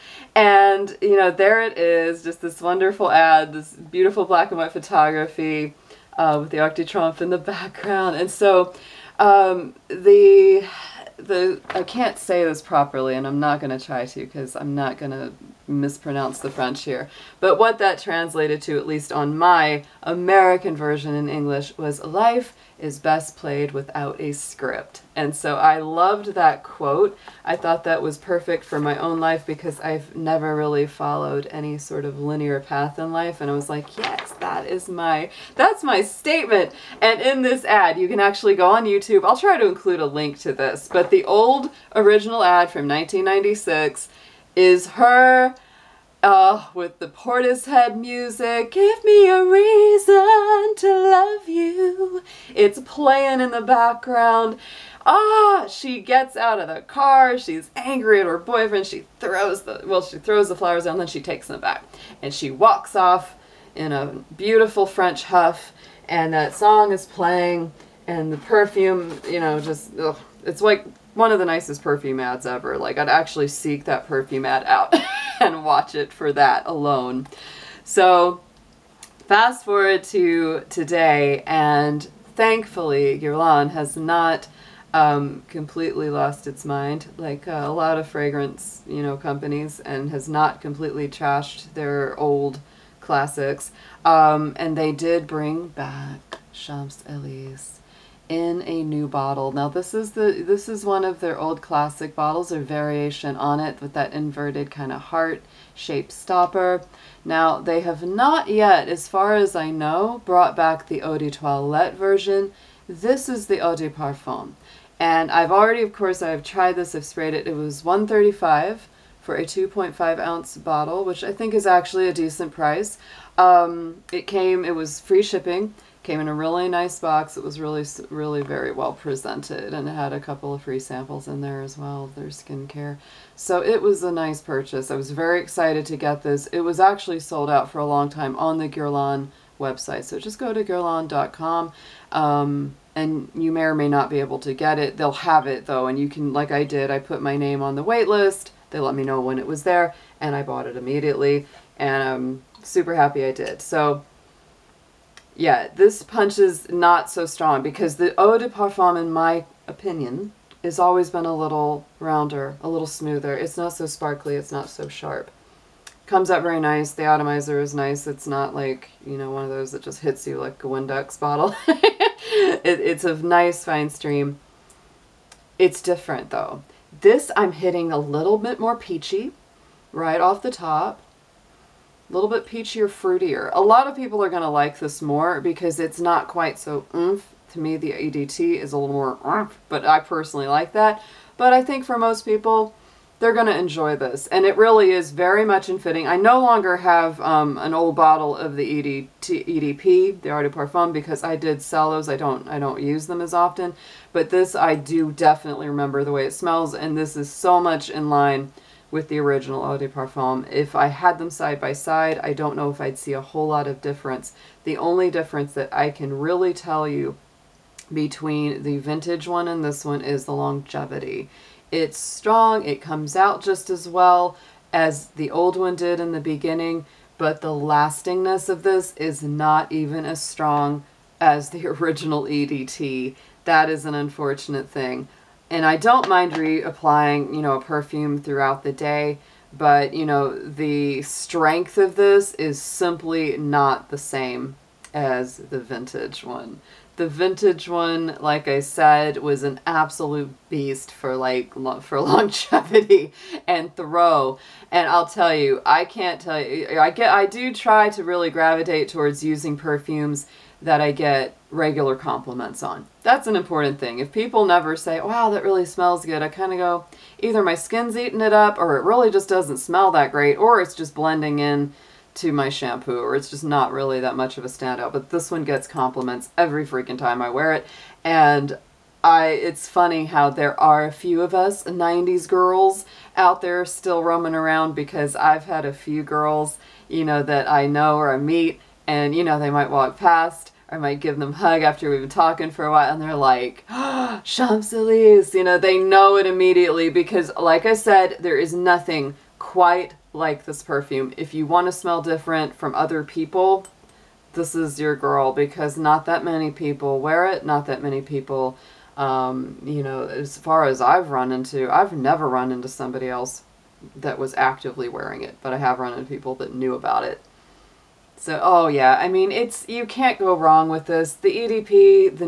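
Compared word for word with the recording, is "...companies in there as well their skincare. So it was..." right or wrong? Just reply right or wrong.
wrong.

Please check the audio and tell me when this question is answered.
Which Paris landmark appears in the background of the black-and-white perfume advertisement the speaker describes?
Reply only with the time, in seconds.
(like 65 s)
6 s.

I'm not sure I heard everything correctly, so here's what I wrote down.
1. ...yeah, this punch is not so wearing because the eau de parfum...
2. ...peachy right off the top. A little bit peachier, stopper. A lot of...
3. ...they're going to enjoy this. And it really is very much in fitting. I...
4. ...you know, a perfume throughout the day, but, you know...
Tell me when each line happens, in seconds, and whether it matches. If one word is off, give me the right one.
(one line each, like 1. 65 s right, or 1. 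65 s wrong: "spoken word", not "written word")
1. 155 s wrong: "strong", not "wearing"
2. 178 s wrong: "fruitier", not "stopper"
3. 193 s right
4. 237 s right.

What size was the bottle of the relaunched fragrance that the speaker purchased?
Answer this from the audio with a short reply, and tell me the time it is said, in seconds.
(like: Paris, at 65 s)
2.5 ounces, at 119 s.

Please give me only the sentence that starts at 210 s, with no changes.
If I had them side by side, I don't know if I'd see a whole lot of difference.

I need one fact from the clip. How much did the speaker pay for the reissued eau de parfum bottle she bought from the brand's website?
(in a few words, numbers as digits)
135.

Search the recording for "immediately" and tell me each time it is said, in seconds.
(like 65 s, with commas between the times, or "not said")
150 s, 296 s.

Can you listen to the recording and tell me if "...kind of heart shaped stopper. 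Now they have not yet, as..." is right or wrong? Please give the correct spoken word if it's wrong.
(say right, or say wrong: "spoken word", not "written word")
right.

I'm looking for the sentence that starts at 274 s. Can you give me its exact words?
But this one gets compliments every freaking time I wear it.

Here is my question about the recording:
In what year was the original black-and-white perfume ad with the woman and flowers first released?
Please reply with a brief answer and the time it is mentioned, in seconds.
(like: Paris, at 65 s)
1996, at 42 s.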